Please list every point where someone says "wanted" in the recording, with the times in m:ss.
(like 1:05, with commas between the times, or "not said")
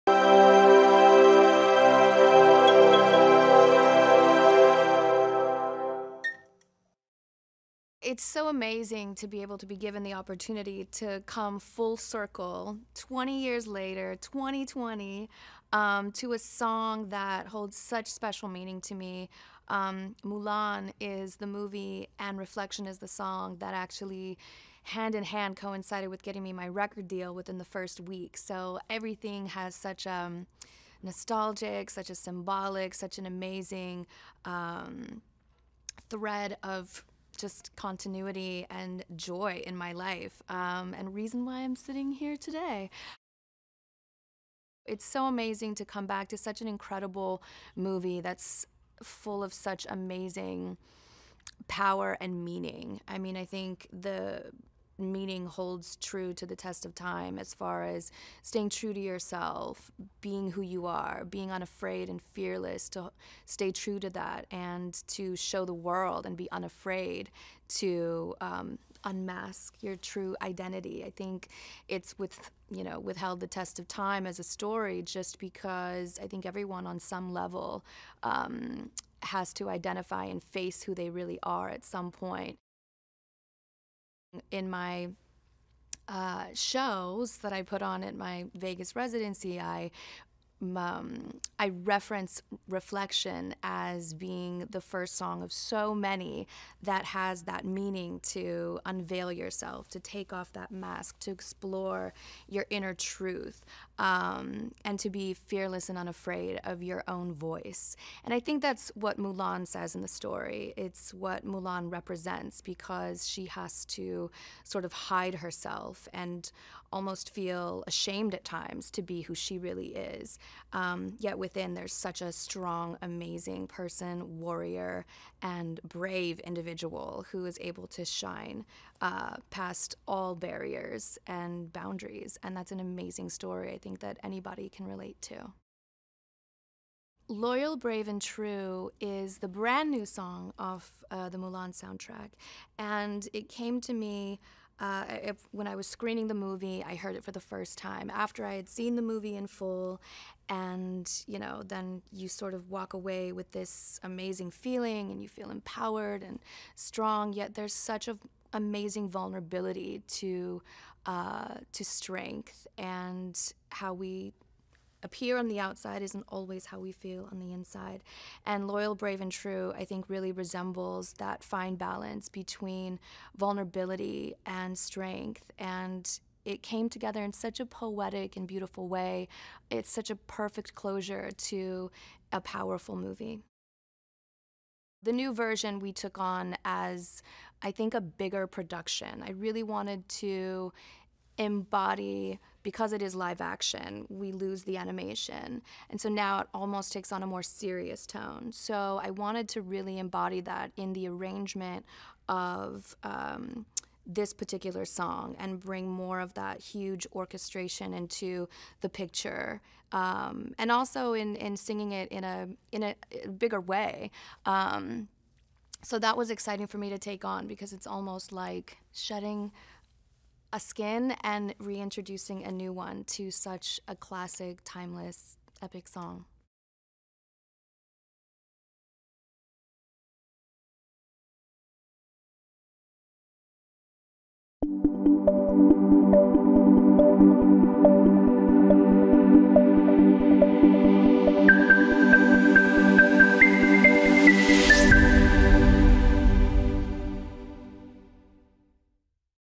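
3:09, 3:19.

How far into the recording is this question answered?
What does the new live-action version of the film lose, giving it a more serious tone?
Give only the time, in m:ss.
3:14.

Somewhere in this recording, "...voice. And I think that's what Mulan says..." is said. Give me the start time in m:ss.
1:47.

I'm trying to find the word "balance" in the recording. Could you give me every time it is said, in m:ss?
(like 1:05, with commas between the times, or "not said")
2:51.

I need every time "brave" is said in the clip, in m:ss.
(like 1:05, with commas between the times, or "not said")
2:05, 2:17, 2:48.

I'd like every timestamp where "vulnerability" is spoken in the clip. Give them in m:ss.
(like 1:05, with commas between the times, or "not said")
2:39, 2:53.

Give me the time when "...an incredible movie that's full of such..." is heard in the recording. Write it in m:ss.
0:46.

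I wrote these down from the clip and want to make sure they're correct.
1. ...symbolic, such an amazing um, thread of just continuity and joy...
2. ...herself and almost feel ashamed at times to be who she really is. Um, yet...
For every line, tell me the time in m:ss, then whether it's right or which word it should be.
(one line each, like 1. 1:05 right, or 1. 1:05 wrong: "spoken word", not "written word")
1. 0:32 right
2. 1:55 right.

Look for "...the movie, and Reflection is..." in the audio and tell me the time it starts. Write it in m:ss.
0:21.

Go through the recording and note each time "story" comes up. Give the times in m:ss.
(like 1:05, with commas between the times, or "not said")
1:14, 1:50, 2:13.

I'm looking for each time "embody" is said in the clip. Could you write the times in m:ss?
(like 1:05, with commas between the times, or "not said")
3:11, 3:19.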